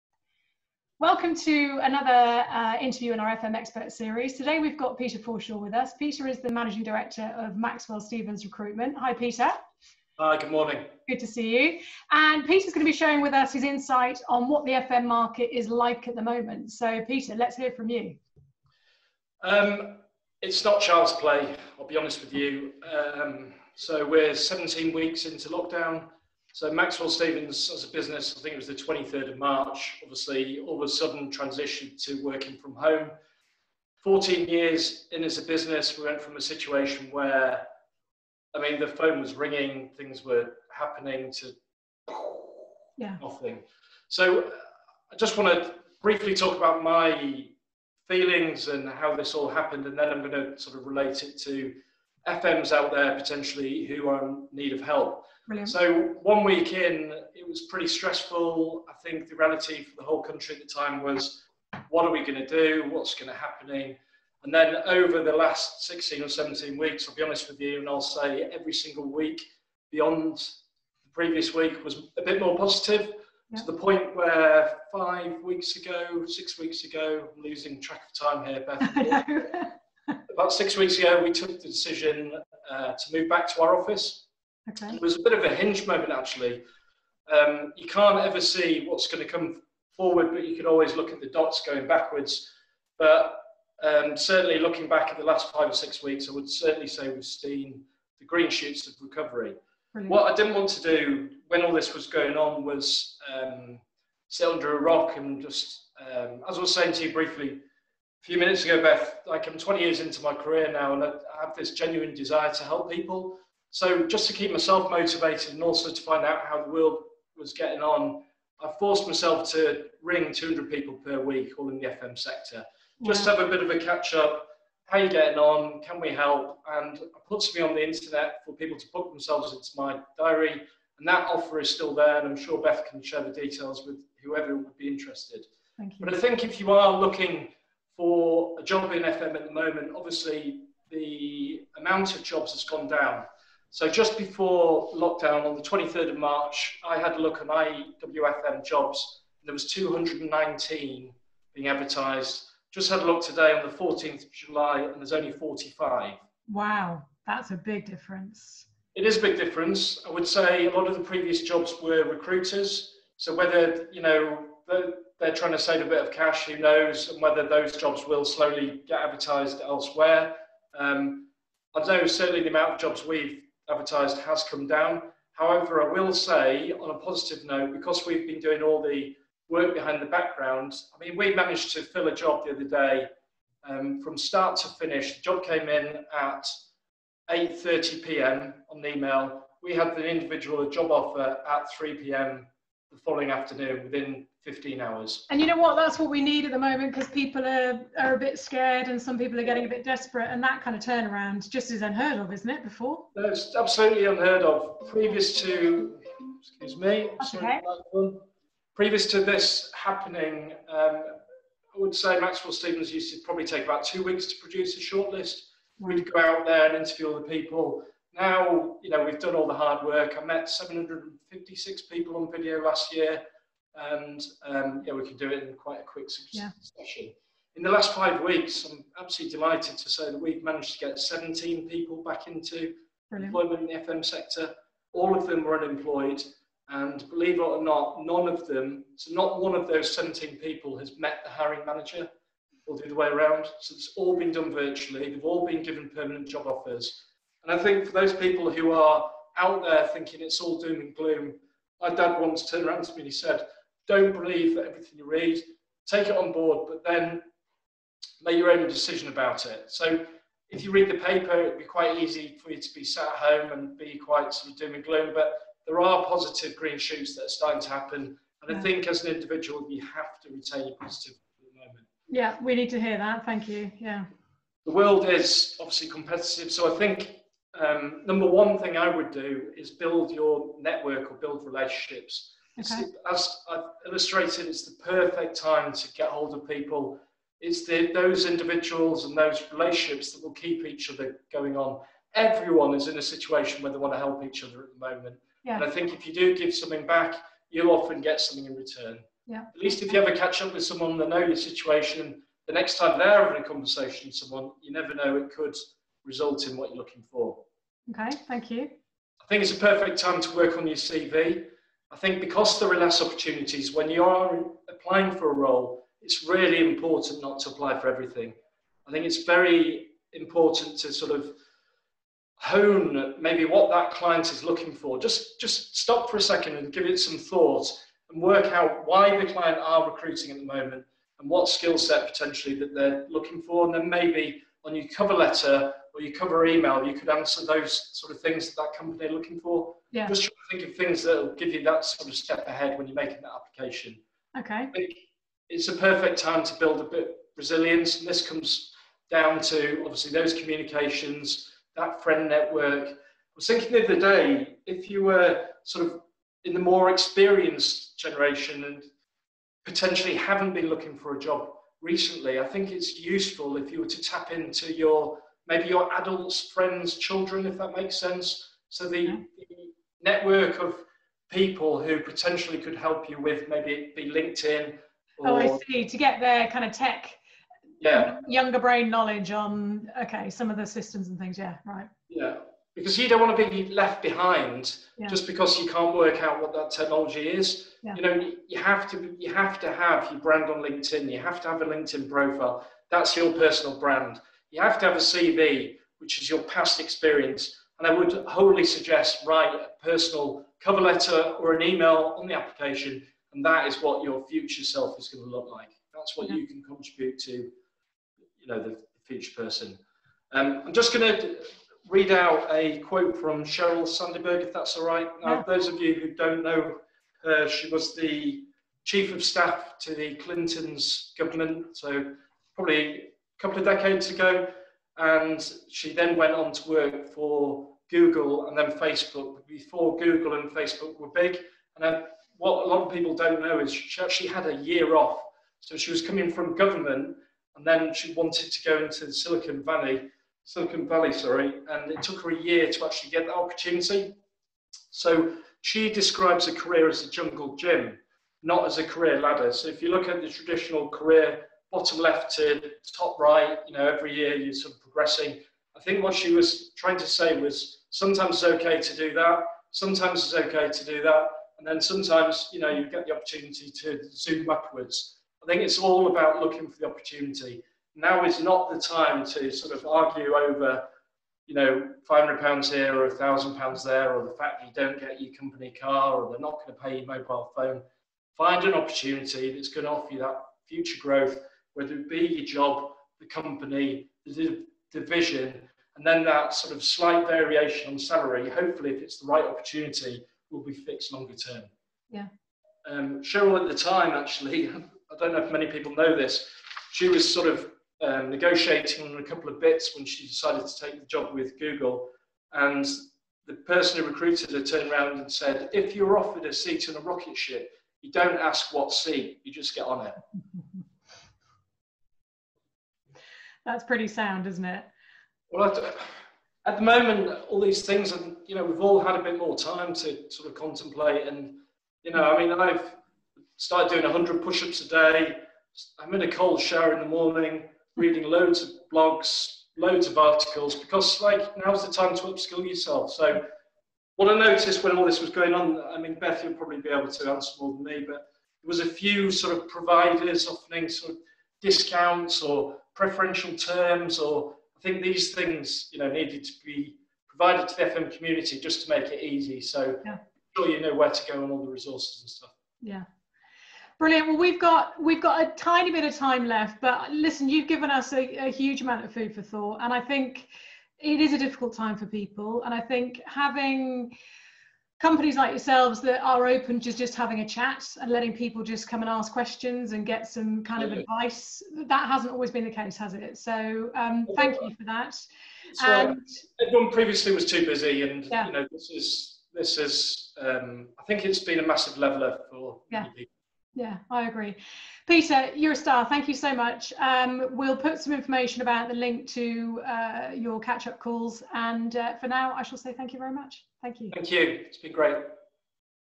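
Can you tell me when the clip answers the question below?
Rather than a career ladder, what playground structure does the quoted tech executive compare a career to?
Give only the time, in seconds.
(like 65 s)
447 s.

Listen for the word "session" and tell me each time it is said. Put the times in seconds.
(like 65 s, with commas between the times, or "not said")
226 s.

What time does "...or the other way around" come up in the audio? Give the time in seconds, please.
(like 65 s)
242 s.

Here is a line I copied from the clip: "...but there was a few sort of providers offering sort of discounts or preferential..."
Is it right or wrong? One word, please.
right.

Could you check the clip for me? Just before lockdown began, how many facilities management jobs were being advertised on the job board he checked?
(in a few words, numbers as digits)
219.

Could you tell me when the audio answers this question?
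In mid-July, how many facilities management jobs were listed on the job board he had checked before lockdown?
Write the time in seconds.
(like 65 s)
155 s.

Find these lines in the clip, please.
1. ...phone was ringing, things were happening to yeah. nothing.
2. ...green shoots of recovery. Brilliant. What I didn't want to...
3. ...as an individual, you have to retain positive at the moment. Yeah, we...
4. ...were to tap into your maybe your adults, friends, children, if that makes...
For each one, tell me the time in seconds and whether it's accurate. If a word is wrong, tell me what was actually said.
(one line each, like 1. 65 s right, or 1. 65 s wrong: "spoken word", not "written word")
1. 38 s right
2. 98 s right
3. 268 s right
4. 363 s right.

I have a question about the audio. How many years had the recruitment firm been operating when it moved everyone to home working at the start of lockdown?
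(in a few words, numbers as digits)
14.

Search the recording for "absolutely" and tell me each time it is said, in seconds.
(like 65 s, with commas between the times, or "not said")
203 s, 229 s.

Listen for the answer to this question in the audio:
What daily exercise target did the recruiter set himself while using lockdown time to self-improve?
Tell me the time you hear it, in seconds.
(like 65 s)
524 s.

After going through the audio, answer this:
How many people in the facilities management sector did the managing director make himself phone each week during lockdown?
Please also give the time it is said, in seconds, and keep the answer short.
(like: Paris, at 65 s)
200, at 120 s.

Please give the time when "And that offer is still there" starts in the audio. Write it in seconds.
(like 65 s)
130 s.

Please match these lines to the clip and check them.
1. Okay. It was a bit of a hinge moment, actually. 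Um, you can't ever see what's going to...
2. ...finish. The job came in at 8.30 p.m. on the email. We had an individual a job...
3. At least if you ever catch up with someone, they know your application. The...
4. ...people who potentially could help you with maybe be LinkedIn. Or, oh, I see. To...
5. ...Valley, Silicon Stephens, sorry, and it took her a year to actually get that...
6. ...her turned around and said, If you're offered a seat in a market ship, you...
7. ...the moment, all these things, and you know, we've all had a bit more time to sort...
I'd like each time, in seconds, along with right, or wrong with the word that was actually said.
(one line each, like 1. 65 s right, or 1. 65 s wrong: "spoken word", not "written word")
1. 84 s right
2. 184 s right
3. 299 s wrong: "situation", not "application"
4. 371 s right
5. 439 s wrong: "Valley", not "Stephens"
6. 504 s wrong: "rocket", not "market"
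7. 516 s right.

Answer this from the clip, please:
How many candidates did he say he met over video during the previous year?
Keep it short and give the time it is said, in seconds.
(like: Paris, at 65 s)
756, at 220 s.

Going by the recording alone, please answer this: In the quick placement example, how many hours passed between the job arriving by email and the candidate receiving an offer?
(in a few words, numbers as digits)
15.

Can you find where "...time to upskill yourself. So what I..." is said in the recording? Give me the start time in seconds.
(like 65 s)
531 s.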